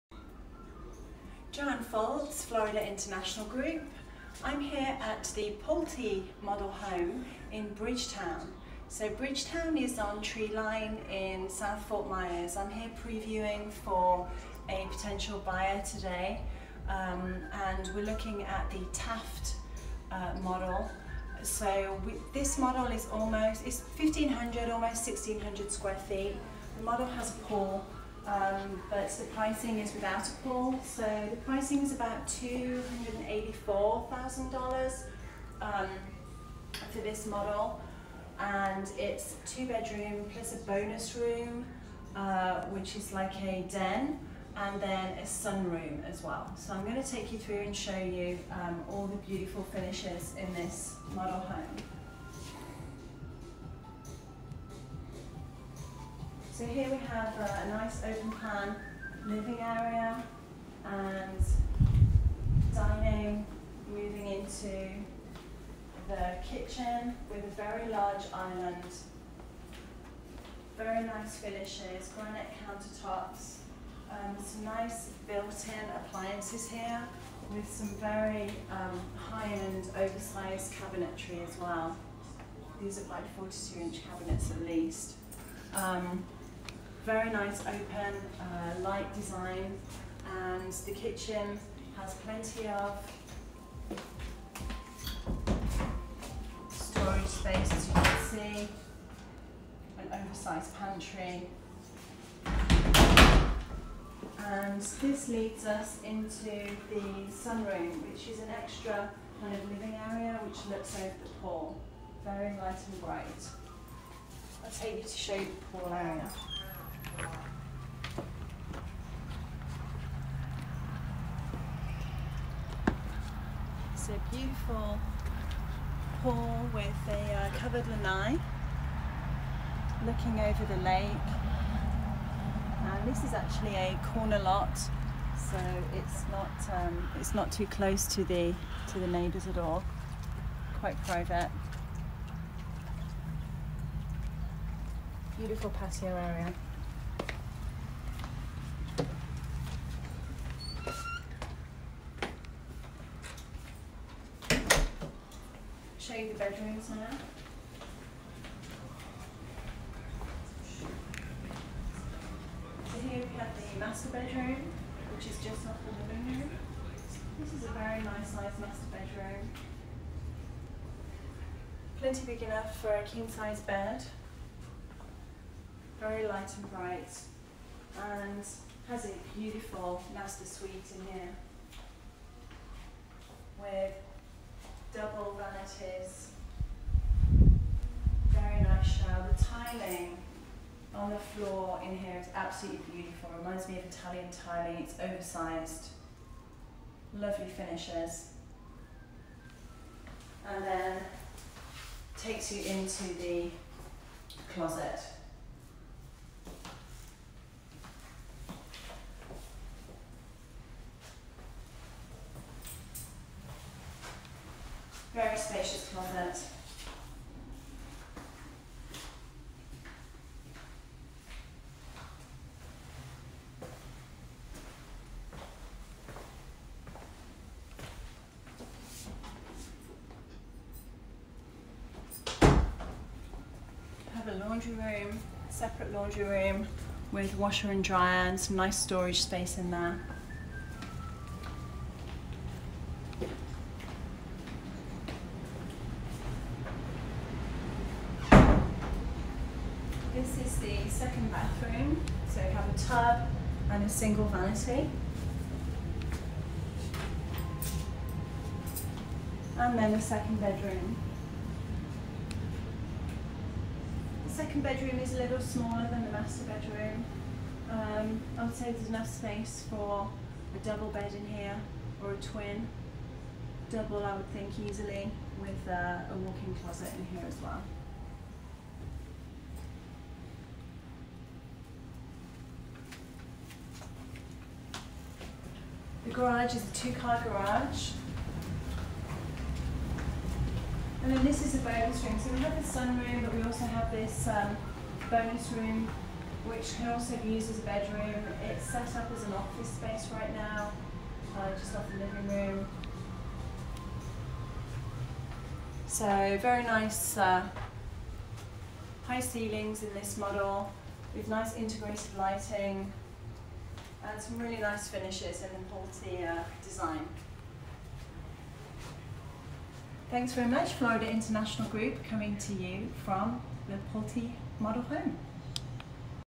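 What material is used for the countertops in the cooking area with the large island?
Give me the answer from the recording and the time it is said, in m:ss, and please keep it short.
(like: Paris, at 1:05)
Granite, at 1:12.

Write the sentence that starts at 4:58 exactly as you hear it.
It's set up as an office space right now, uh, just off the living room.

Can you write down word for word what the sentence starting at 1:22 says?
These are like 42-inch cabinets at least.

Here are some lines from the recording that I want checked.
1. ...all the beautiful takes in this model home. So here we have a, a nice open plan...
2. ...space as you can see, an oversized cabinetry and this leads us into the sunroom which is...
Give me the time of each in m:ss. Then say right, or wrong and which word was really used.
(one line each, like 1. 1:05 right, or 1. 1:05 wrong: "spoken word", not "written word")
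1. 0:48 wrong: "finishes", not "takes"
2. 1:37 wrong: "pantry", not "cabinetry".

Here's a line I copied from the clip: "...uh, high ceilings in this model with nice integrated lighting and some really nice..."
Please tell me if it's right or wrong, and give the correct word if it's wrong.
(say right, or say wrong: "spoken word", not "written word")
right.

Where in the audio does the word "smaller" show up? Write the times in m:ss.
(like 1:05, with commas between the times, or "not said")
4:25.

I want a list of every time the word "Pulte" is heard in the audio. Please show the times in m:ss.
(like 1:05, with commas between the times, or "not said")
0:05, 5:16, 5:23.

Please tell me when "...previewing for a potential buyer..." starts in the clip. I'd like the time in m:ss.
0:13.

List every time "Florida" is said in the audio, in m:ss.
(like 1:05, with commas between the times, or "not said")
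0:02, 5:20.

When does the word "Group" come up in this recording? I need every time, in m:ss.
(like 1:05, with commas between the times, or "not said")
0:03, 5:21.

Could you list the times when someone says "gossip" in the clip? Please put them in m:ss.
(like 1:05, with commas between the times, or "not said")
not said.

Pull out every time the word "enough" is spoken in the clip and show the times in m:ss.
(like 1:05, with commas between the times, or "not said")
2:52, 4:28.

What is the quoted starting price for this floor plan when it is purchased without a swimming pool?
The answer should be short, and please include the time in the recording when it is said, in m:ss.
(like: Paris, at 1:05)
$284,000, at 0:32.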